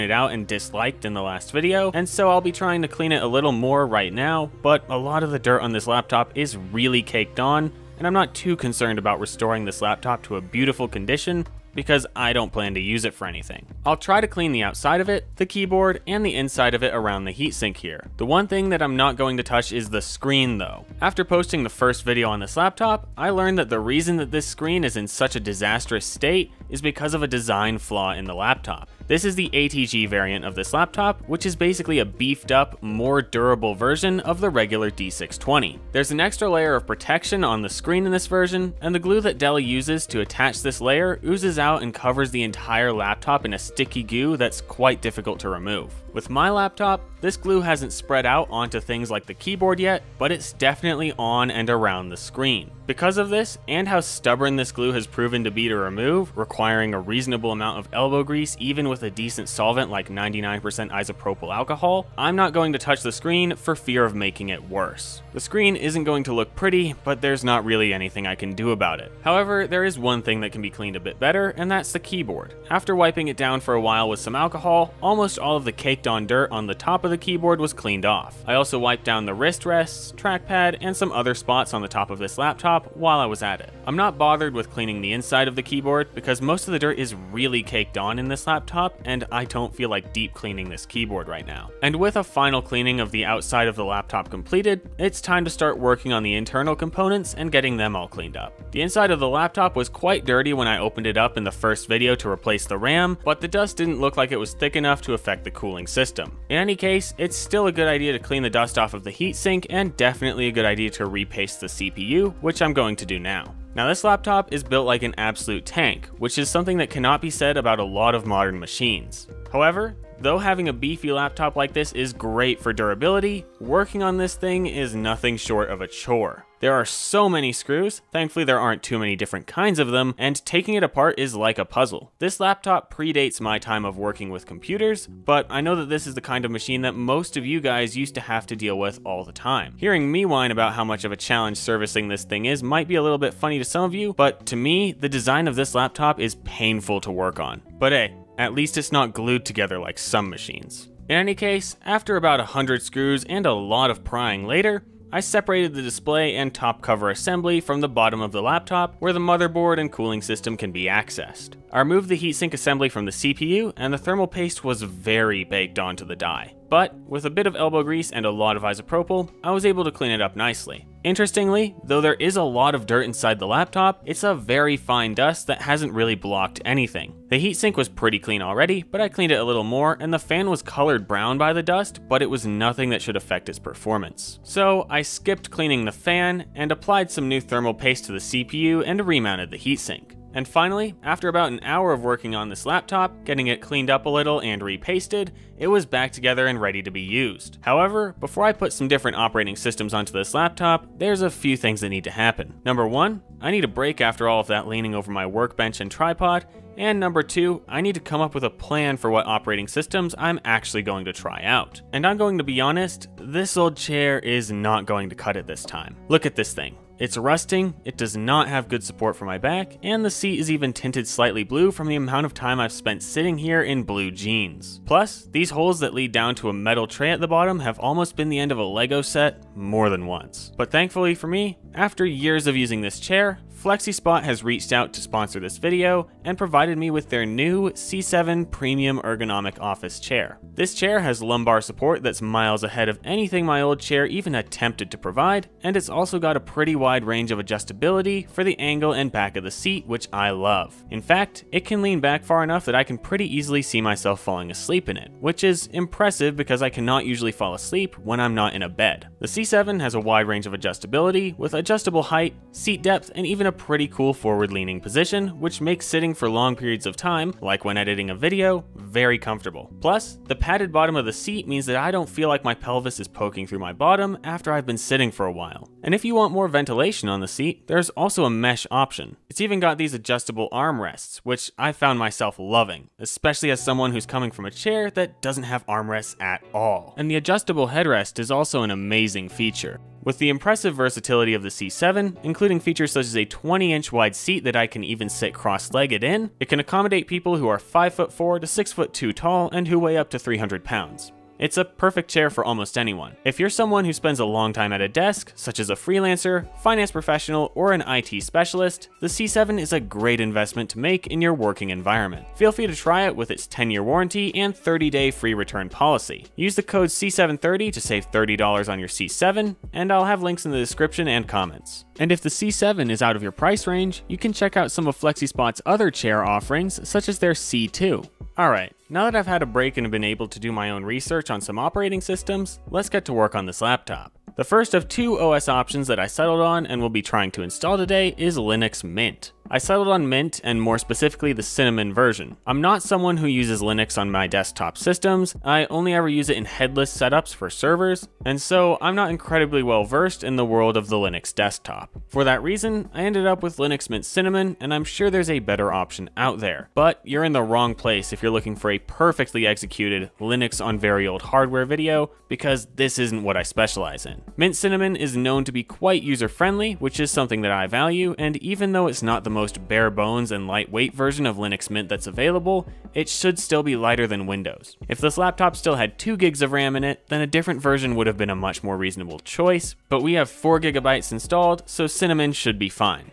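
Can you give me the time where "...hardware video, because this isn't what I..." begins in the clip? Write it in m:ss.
6:01.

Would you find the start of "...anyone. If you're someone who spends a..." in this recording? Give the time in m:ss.
5:02.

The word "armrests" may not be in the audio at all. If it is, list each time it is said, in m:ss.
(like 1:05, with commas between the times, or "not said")
4:40, 4:45.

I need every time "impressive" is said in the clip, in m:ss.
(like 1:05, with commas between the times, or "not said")
4:15, 4:50.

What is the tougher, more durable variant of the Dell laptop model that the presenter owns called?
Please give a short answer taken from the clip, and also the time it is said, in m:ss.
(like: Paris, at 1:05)
ATG, at 0:29.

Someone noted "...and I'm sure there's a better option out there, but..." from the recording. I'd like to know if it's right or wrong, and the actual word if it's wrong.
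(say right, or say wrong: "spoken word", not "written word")
right.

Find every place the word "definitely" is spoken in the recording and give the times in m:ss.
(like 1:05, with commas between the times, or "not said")
0:50, 1:49.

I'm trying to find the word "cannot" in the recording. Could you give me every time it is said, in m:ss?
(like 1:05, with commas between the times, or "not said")
1:56, 4:16.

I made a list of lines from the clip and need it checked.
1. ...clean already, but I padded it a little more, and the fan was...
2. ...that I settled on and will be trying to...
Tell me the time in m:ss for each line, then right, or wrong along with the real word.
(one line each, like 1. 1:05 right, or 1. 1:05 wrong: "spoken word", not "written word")
1. 2:58 wrong: "cleaned", not "padded"
2. 5:35 right.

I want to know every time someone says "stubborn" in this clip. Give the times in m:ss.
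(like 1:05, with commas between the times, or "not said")
0:54.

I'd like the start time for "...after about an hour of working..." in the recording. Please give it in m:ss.
3:11.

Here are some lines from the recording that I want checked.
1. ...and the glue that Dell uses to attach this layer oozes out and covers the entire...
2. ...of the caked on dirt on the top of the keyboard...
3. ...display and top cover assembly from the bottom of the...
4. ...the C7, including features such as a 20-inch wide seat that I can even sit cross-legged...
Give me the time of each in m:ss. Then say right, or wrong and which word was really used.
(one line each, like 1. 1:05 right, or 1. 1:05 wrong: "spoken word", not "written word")
1. 0:38 right
2. 1:15 right
3. 2:35 right
4. 4:51 right.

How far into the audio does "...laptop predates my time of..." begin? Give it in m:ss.
2:12.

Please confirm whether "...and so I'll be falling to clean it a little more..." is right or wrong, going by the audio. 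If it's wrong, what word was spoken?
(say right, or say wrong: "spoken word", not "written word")
wrong: "trying", not "falling".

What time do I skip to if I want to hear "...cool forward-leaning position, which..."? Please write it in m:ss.
4:23.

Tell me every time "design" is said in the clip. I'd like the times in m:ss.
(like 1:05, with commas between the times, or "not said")
0:27, 2:25.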